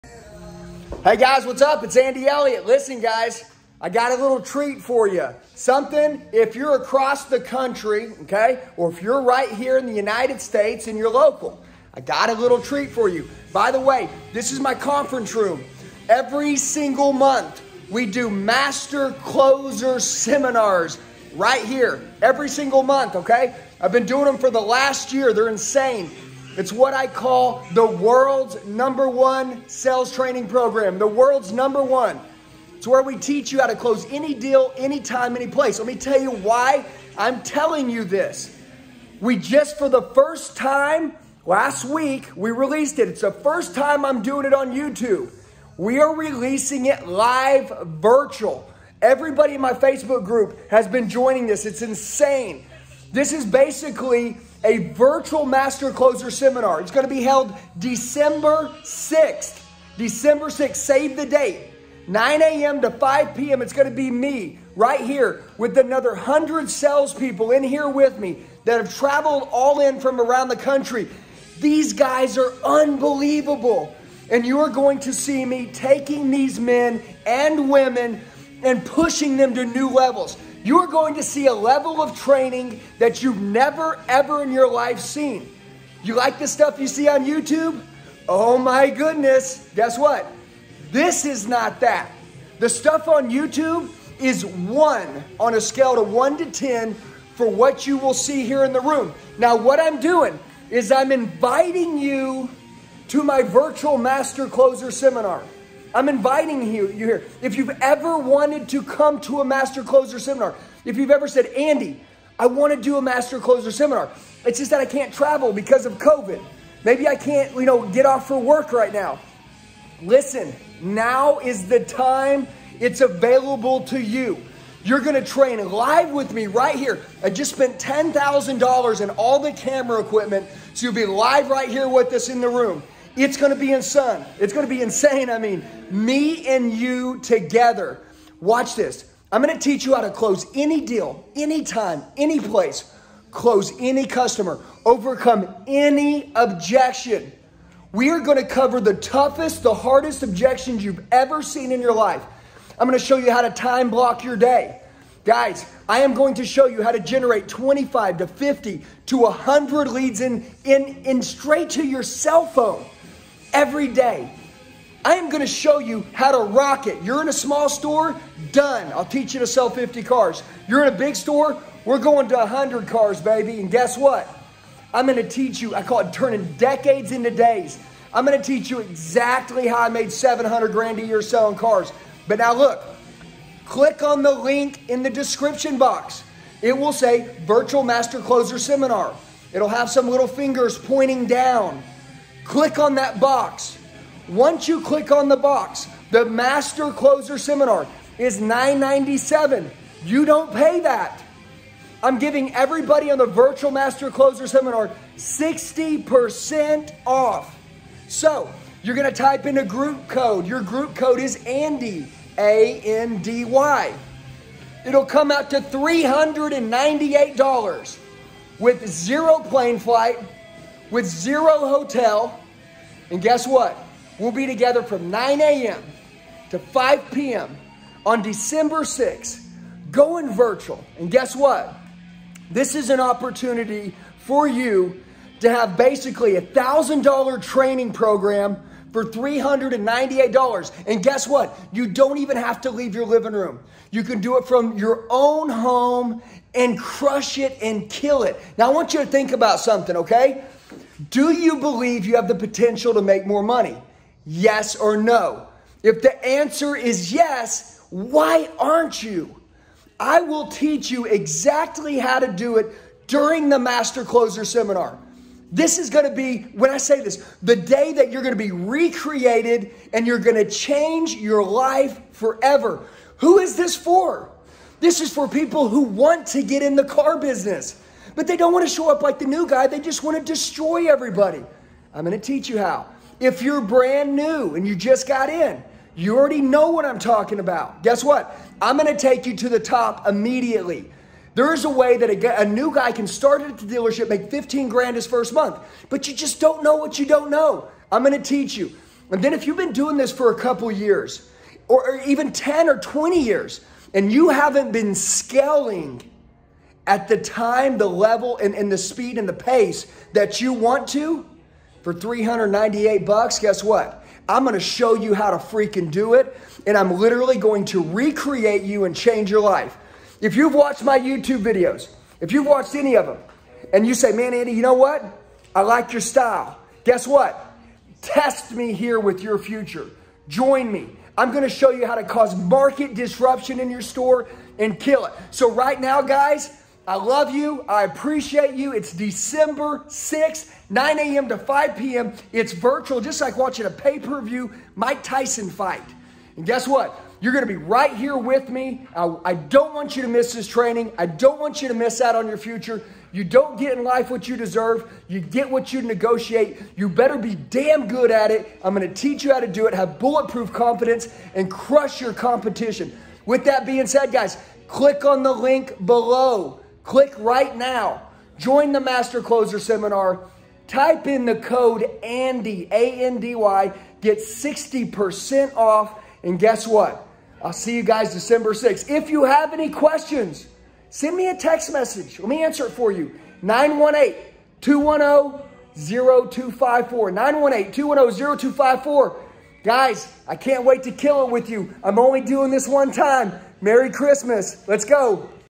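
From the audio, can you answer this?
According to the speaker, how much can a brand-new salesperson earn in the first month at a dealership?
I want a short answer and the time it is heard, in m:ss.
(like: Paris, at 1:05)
15 grand, at 4:54.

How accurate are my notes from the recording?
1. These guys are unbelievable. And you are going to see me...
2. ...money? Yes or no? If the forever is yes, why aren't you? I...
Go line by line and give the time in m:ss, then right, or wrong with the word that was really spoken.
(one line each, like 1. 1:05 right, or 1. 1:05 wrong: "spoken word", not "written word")
1. 1:11 right
2. 4:13 wrong: "answer", not "forever".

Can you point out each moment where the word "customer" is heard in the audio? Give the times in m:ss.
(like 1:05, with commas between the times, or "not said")
2:24.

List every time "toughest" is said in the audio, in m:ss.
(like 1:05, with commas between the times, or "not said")
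2:28.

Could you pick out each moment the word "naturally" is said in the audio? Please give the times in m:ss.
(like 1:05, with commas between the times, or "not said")
not said.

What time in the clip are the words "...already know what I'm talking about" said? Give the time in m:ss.
4:46.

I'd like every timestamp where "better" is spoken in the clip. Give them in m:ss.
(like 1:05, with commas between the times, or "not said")
5:56.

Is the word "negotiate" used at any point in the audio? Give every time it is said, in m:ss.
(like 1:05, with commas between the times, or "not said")
5:55.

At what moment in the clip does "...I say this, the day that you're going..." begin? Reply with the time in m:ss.
4:26.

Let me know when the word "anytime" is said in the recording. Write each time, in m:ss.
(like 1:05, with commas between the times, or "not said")
0:34, 2:21.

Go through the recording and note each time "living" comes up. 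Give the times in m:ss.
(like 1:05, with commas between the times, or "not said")
4:03.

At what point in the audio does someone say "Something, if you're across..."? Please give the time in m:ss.
0:05.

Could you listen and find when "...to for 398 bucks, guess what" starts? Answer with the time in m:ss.
5:10.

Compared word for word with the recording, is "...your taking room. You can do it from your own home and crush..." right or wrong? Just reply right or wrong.
wrong.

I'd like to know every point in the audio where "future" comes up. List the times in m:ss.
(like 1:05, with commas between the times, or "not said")
5:29, 5:52.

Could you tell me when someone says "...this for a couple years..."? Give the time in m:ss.
4:59.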